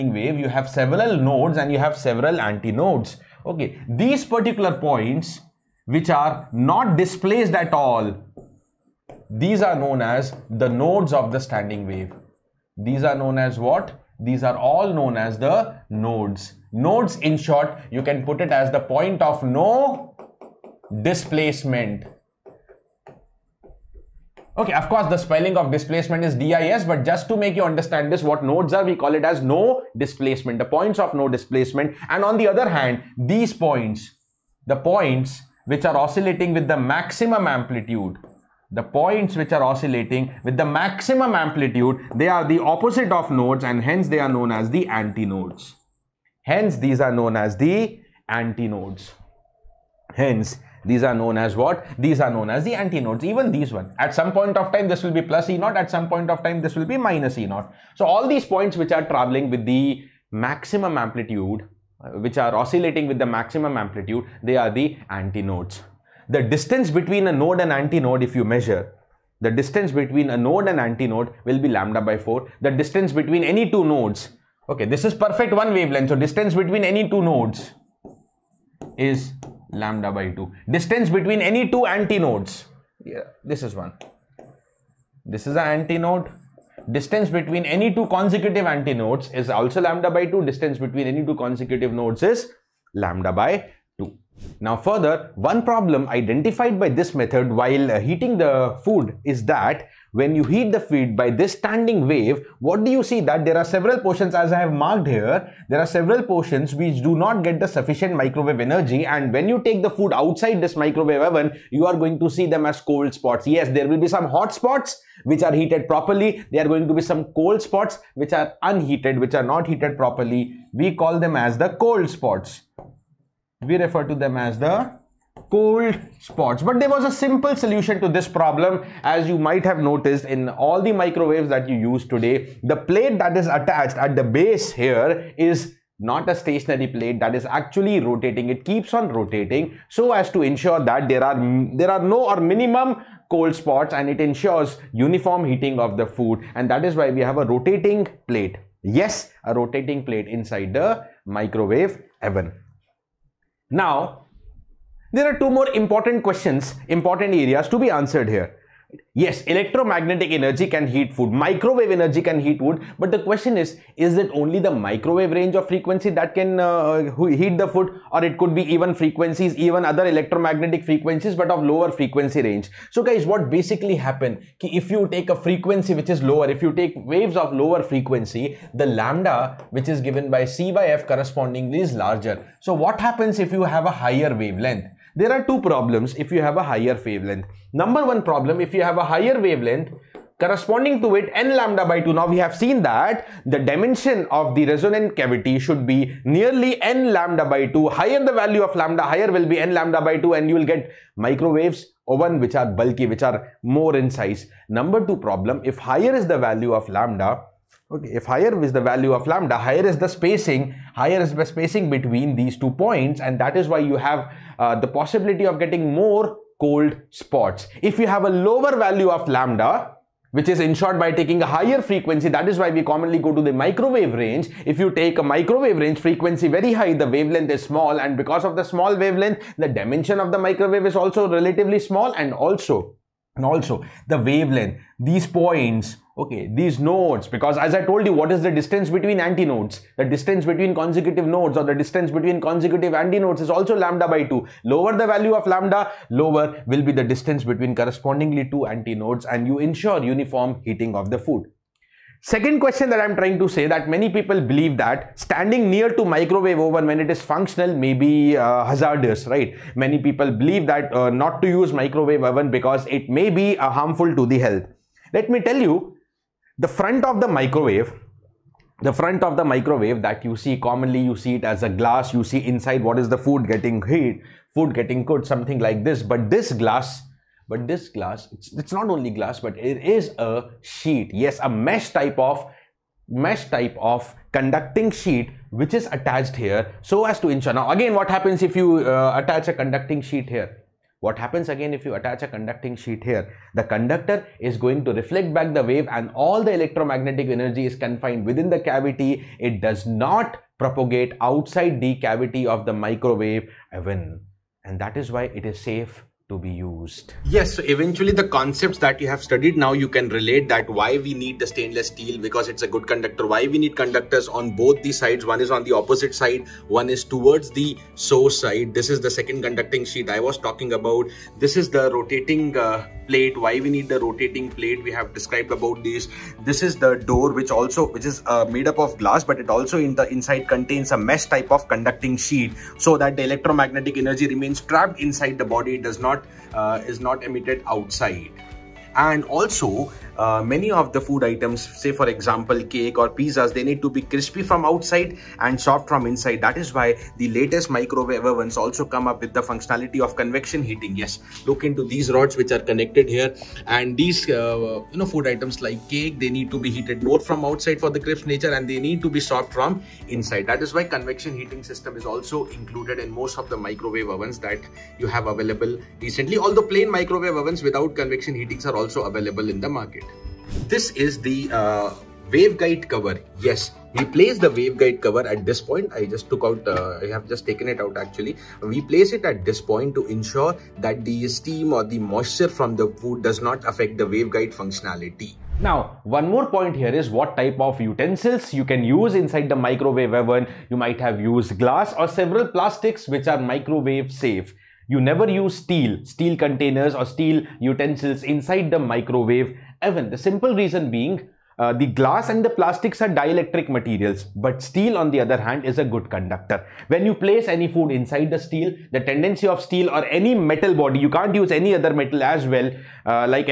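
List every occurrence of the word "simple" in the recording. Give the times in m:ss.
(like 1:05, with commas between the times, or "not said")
2:07, 6:40.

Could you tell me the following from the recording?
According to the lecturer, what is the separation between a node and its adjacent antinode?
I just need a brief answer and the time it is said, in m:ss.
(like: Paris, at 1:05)
lambda by 4, at 1:11.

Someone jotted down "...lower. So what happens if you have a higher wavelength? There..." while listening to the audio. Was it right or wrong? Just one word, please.
wrong.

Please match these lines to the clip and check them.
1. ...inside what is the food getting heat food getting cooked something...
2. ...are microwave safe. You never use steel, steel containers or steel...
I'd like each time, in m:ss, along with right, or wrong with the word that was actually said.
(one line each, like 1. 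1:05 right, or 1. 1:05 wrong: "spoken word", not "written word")
1. 4:32 right
2. 6:33 right.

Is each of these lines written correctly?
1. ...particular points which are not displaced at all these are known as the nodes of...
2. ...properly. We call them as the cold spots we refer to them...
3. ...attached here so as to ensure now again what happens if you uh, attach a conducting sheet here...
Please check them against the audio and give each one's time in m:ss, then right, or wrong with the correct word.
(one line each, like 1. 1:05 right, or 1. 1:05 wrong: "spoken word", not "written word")
1. 0:04 right
2. 1:59 right
3. 4:45 right.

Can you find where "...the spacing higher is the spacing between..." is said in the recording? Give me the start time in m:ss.
3:29.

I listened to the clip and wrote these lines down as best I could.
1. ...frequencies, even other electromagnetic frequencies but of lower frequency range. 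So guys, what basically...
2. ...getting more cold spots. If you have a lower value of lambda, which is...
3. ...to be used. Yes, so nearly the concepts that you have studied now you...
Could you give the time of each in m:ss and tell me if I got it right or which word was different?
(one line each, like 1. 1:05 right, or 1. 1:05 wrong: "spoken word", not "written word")
1. 2:48 right
2. 3:35 right
3. 5:06 wrong: "eventually", not "nearly".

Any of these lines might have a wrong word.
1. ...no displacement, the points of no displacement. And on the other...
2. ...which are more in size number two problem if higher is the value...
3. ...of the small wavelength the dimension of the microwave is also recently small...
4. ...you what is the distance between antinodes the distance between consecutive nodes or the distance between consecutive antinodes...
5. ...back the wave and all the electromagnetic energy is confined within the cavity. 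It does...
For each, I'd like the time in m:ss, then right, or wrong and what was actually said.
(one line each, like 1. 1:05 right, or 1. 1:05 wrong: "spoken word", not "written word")
1. 0:29 right
2. 3:23 right
3. 3:48 wrong: "relatively", not "recently"
4. 3:58 right
5. 4:55 right.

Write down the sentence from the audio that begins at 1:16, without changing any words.
So distance between any two nodes is lambda by 2.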